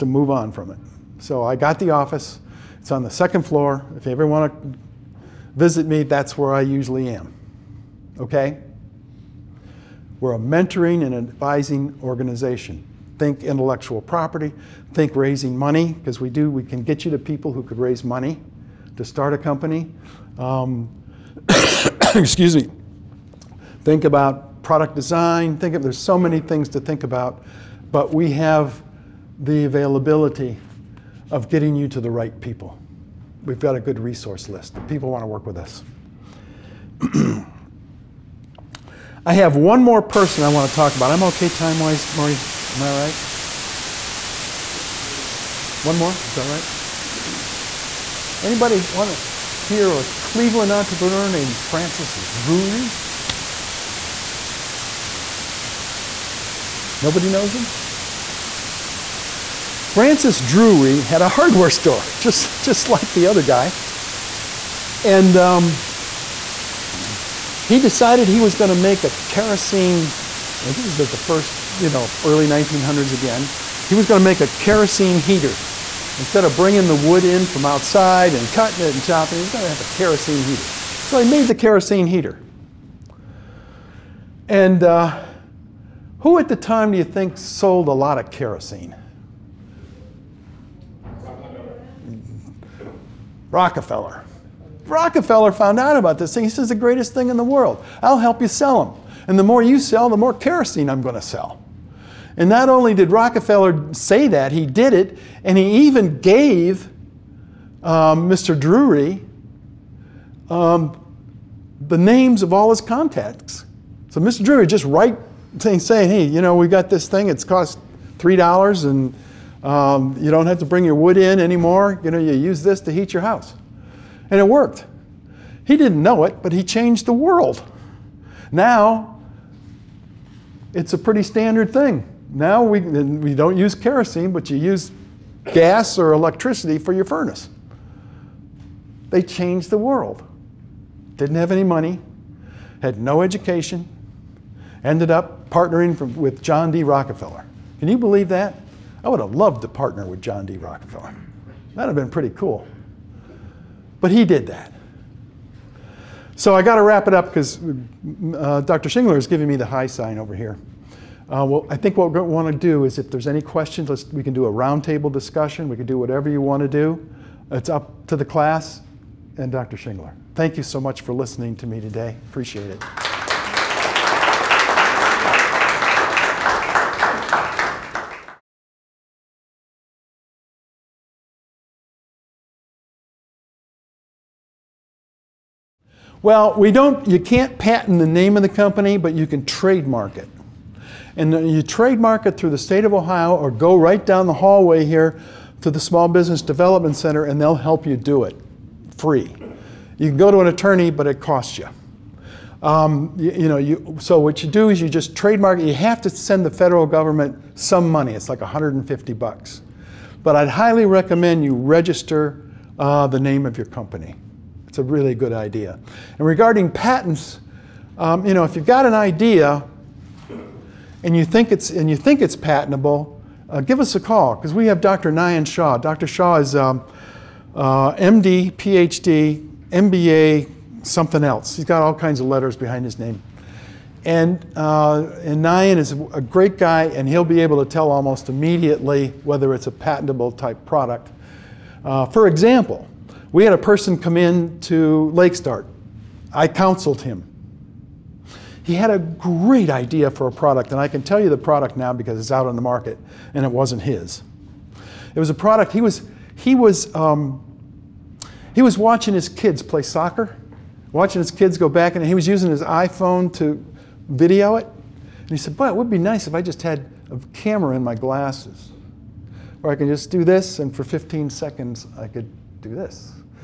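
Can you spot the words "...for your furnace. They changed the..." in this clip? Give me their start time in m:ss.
2:16.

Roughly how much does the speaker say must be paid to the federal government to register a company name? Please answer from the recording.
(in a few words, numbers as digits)
$150.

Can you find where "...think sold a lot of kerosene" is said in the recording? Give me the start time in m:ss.
1:27.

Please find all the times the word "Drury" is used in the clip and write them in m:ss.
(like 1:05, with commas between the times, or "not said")
0:52, 1:00, 1:48, 1:54.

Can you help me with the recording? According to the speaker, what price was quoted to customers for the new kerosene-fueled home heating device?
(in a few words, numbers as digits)
$3.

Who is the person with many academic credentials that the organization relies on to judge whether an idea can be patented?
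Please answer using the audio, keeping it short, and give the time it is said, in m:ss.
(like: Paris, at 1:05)
Dr. Nayan Shaw, at 3:44.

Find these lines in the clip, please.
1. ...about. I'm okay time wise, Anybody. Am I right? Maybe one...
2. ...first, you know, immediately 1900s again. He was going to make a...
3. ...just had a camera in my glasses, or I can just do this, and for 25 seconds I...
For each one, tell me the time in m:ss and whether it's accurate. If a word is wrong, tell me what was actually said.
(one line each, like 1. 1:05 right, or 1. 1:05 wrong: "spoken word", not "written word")
1. 0:40 wrong: "Marty", not "Anybody"
2. 1:11 wrong: "early", not "immediately"
3. 4:26 wrong: "15", not "25".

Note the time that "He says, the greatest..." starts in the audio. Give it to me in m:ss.
1:36.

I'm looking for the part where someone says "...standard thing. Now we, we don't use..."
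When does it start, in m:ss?
2:11.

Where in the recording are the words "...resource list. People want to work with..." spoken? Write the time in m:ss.
0:33.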